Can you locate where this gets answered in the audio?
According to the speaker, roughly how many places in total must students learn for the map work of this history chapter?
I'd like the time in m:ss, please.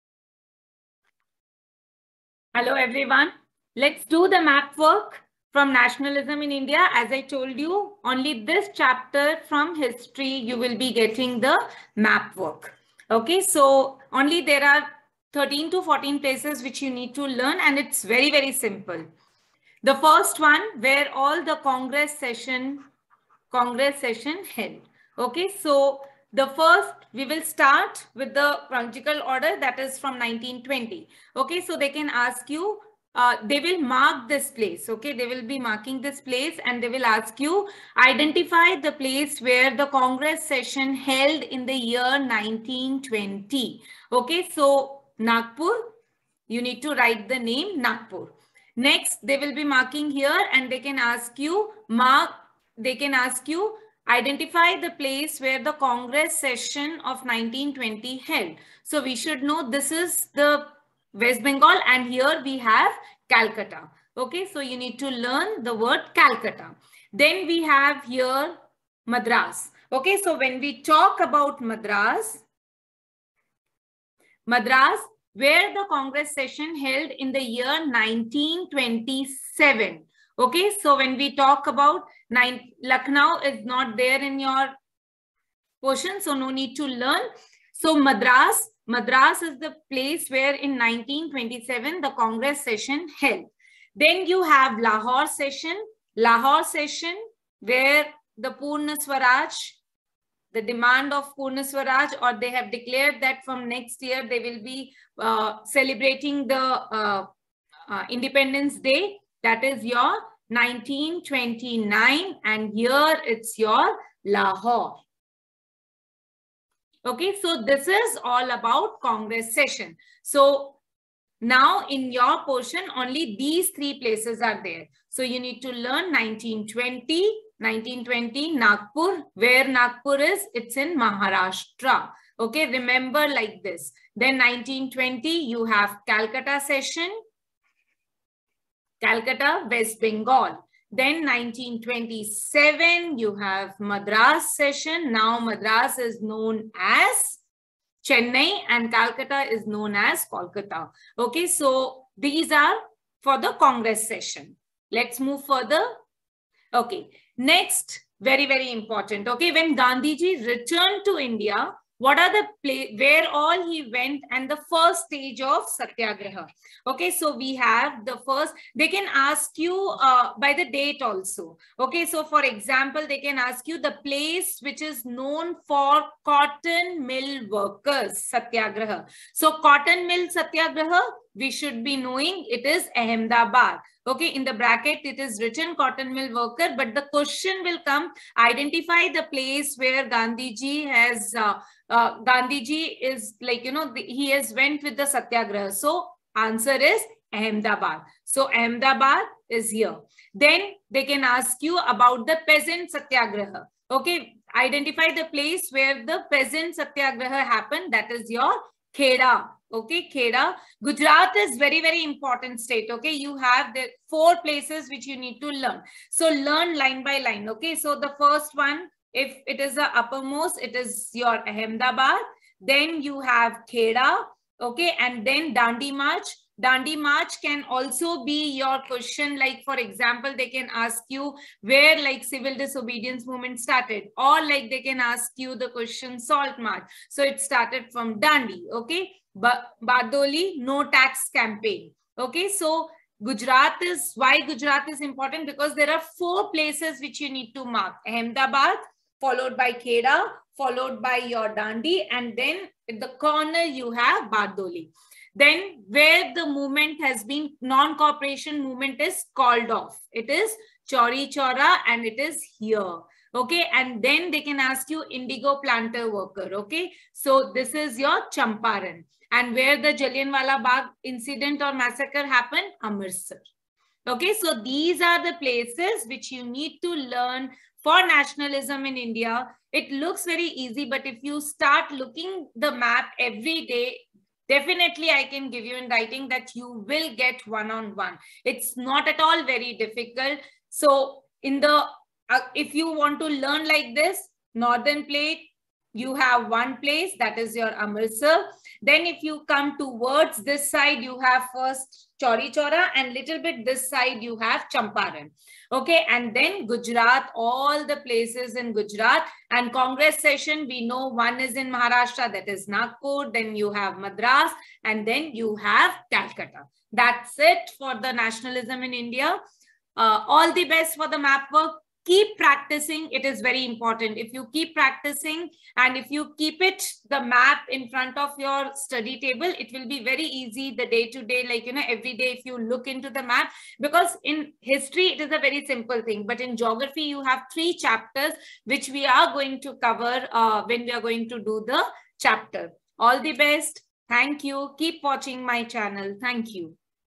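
0:15.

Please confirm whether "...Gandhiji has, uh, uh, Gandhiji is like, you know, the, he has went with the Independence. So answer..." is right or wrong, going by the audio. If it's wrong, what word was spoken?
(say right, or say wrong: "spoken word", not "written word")
wrong: "Satyagraha", not "Independence".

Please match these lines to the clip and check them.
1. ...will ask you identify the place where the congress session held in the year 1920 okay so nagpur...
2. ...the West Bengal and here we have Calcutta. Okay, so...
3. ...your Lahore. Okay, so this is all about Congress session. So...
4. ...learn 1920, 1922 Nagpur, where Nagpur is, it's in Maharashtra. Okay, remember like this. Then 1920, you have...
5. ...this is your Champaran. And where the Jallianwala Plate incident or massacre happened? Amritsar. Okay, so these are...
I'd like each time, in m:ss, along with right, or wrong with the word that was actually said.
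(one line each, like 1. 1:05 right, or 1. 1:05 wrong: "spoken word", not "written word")
1. 0:36 right
2. 1:00 right
3. 1:53 right
4. 2:05 wrong: "1920", not "1922"
5. 4:27 wrong: "Bagh", not "Plate".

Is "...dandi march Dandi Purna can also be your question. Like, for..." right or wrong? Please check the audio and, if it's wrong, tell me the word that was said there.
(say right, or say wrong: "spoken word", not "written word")
wrong: "March", not "Purna".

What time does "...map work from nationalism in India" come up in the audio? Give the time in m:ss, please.
0:04.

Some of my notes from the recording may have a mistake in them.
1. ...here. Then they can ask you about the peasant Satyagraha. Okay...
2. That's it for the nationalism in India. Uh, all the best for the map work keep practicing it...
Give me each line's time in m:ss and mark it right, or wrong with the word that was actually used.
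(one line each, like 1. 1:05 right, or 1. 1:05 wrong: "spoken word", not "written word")
1. 3:19 right
2. 5:16 right.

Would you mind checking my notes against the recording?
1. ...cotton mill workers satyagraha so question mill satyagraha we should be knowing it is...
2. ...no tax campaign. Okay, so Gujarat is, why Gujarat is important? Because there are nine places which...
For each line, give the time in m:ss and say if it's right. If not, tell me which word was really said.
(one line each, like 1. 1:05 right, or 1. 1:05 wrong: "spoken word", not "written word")
1. 2:56 wrong: "cotton", not "question"
2. 4:00 wrong: "four", not "nine".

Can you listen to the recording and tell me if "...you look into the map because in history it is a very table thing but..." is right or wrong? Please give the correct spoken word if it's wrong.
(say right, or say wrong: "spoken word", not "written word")
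wrong: "simple", not "table".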